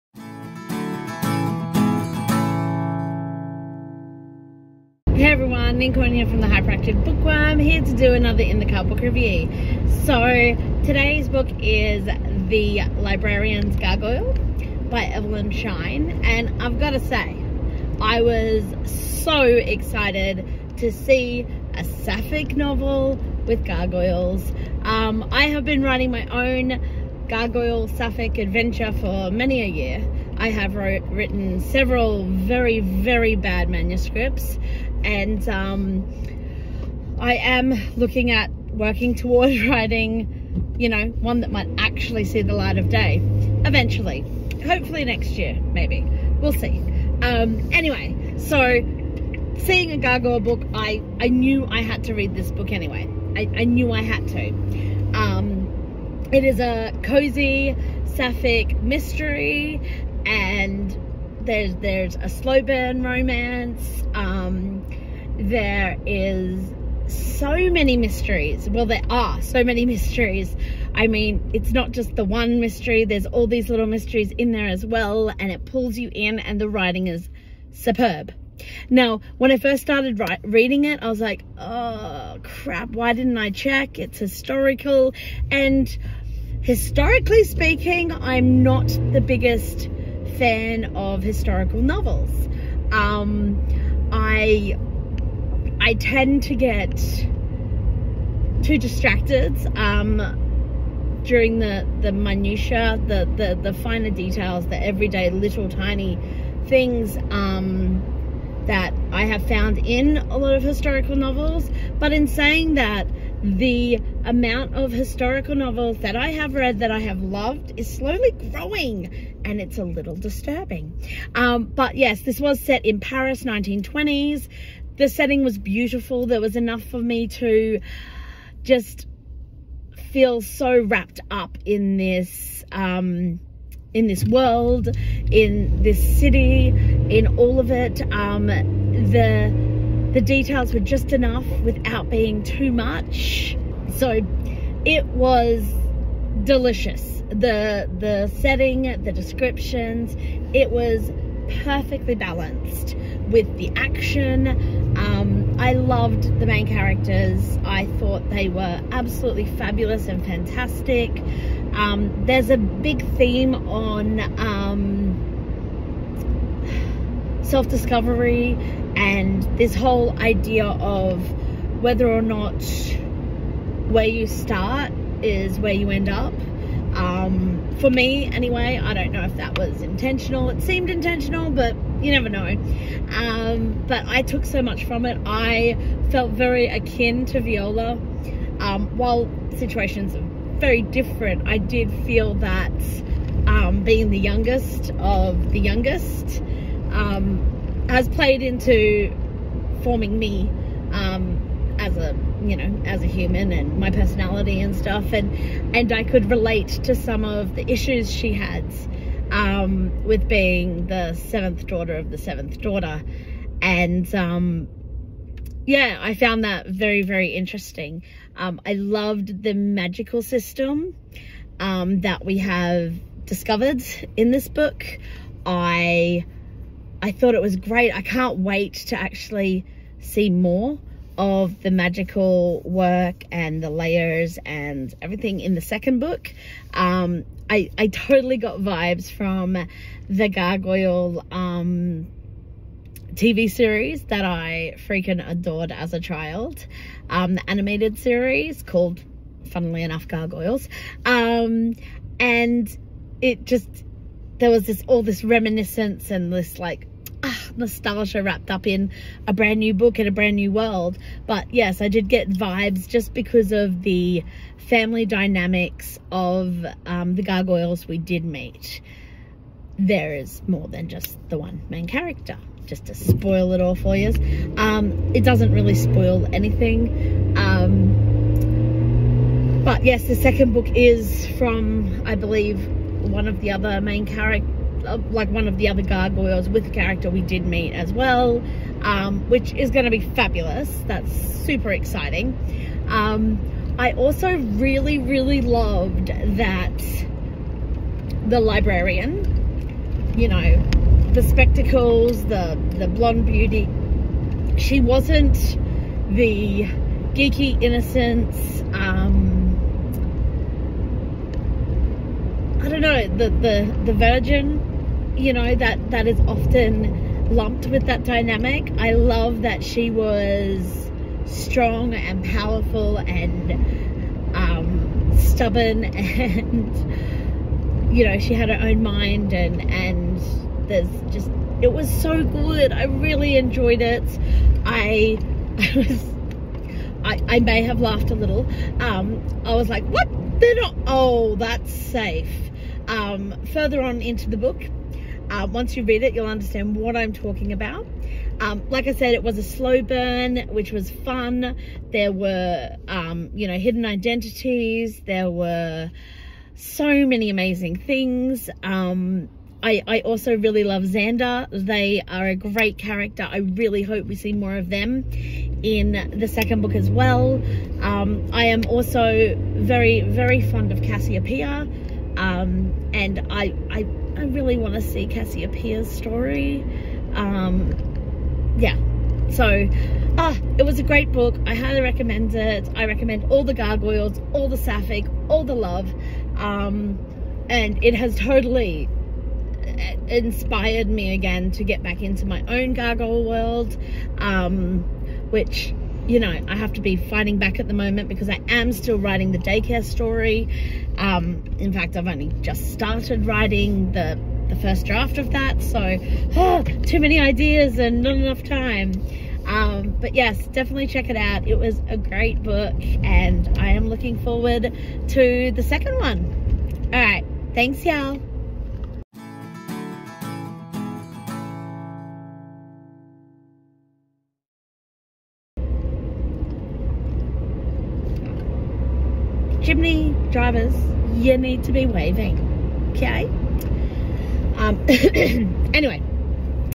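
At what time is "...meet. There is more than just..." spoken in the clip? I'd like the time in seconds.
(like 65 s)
268 s.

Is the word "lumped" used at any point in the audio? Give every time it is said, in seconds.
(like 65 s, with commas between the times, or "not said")
317 s.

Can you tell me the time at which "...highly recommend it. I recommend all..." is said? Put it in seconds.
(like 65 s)
381 s.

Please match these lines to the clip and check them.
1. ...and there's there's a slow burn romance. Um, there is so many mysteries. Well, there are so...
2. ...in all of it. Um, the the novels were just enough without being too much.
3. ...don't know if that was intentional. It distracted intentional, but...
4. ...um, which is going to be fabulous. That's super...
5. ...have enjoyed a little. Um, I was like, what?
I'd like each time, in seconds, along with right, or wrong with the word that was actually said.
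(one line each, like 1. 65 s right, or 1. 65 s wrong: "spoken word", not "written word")
1. 60 s right
2. 136 s wrong: "details", not "novels"
3. 178 s wrong: "seemed", not "distracted"
4. 288 s right
5. 337 s wrong: "laughed", not "enjoyed".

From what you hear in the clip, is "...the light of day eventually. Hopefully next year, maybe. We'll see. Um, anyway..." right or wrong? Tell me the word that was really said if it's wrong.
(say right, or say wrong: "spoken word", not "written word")
right.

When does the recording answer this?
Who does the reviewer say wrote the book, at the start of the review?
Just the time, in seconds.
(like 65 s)
15 s.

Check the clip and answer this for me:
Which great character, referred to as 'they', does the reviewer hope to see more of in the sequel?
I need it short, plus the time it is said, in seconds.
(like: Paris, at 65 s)
Xander, at 360 s.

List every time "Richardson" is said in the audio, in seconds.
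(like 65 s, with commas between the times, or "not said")
not said.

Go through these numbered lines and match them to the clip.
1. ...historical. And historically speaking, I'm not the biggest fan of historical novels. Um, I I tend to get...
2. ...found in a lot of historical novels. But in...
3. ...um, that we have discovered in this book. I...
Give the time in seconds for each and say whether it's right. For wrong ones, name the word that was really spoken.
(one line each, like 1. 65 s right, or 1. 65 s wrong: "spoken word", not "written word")
1. 84 s right
2. 109 s right
3. 221 s right.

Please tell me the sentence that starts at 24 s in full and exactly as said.
Um, I have been writing my own gargoyle sapphic adventure for many a year.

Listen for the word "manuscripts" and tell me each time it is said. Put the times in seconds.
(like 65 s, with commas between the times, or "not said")
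33 s.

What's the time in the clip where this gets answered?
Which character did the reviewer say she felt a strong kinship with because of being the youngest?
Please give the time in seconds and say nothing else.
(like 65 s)
187 s.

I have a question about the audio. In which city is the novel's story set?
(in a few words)
Paris.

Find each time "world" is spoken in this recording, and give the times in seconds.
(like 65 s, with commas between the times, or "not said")
134 s, 260 s, 393 s.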